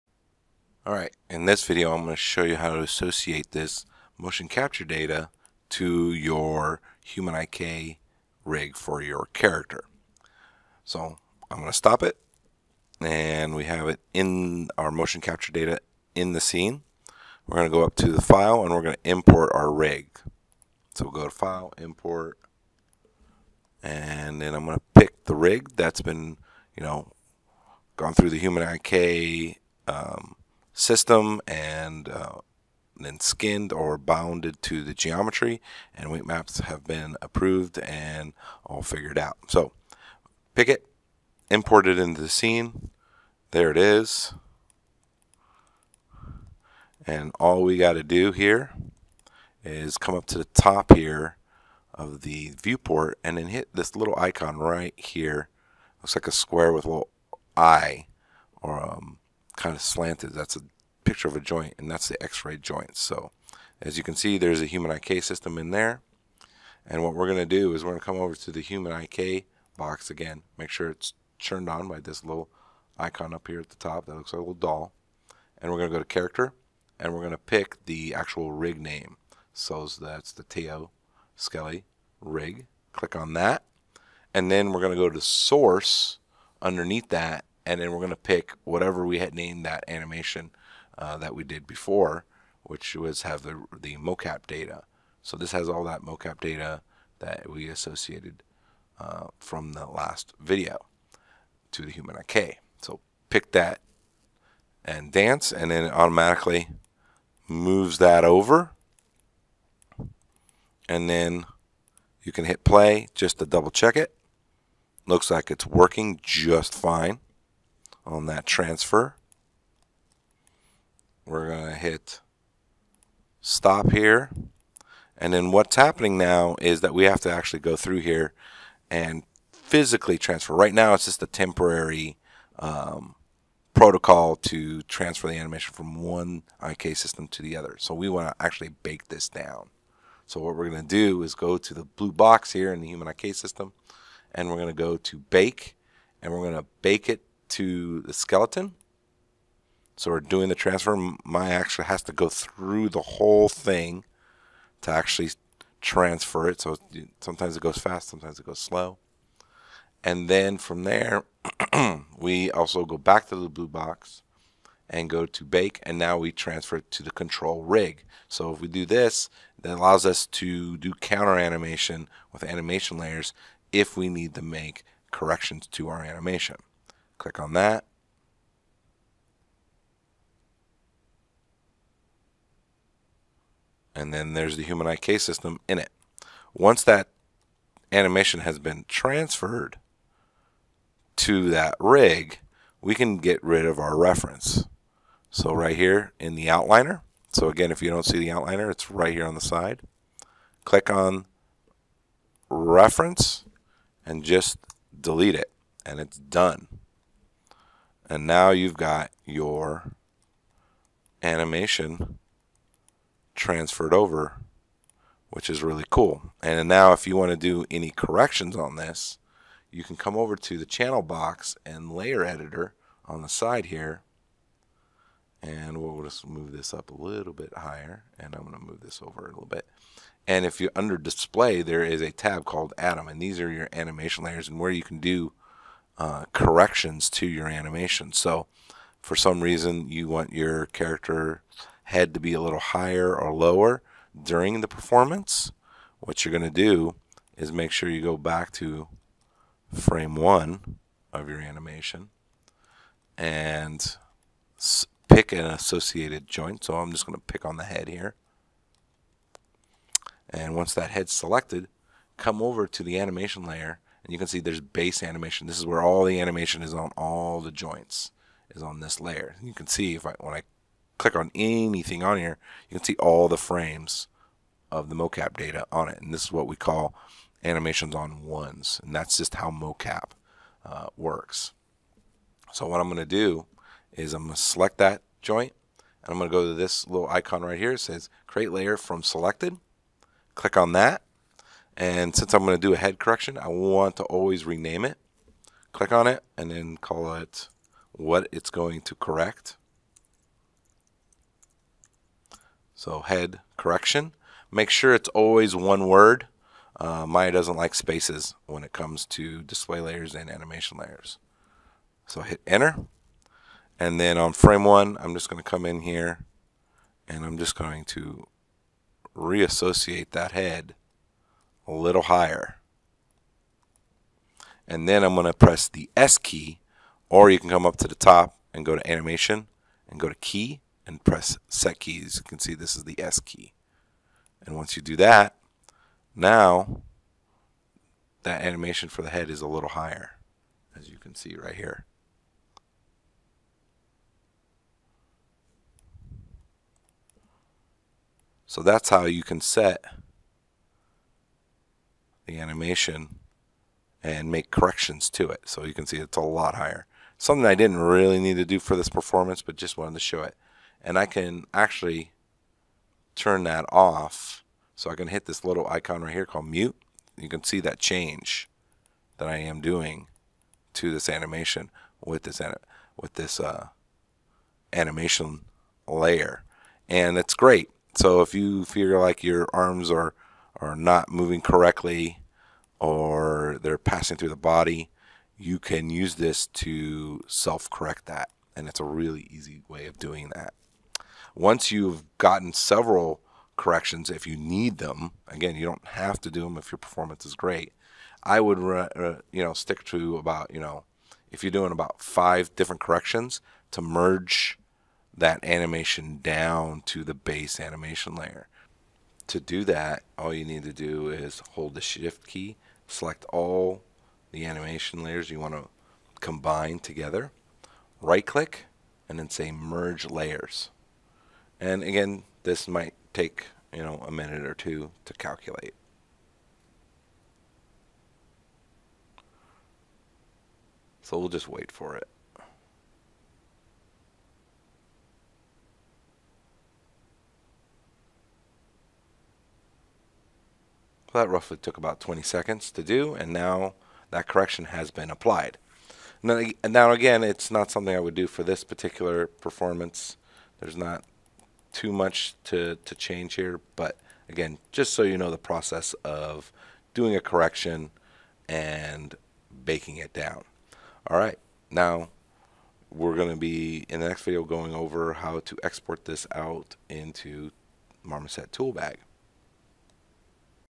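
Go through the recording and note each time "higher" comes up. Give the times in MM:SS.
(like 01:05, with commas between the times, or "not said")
03:47, 04:02, 05:22, 05:39, 05:56.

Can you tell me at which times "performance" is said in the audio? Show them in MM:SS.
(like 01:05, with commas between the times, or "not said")
04:04, 05:58, 06:36, 07:29.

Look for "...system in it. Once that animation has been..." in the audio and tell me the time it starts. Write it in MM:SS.
03:05.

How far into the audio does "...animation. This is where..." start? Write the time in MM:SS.
04:25.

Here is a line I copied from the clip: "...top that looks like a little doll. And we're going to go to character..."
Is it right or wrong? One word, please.
right.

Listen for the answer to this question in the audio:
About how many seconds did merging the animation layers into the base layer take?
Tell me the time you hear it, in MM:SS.
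07:21.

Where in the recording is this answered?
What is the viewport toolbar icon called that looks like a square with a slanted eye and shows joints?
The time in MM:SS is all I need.
01:02.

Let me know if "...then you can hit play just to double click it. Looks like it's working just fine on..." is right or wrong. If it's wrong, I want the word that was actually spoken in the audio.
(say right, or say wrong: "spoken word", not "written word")
wrong: "check", not "click".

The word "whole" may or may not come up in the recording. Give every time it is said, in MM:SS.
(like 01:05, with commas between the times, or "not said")
02:33.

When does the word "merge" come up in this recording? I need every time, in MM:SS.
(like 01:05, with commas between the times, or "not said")
06:43, 06:59.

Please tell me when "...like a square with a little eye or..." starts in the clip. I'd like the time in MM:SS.
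00:56.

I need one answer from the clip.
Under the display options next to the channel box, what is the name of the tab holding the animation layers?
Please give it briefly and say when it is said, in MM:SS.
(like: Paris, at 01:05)
Atom, at 03:52.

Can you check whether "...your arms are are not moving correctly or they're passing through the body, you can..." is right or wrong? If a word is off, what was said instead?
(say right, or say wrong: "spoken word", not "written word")
right.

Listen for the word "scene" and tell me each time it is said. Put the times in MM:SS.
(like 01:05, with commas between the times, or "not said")
00:16, 00:42.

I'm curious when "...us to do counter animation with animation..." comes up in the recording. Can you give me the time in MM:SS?
02:50.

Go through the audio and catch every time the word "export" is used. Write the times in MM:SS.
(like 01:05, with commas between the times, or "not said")
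07:45.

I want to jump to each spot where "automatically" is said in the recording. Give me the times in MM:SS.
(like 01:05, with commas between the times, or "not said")
01:45.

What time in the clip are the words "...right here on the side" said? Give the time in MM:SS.
03:18.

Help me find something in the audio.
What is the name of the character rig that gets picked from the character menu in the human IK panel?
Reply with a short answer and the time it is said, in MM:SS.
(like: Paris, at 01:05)
Teo Skelly, at 01:20.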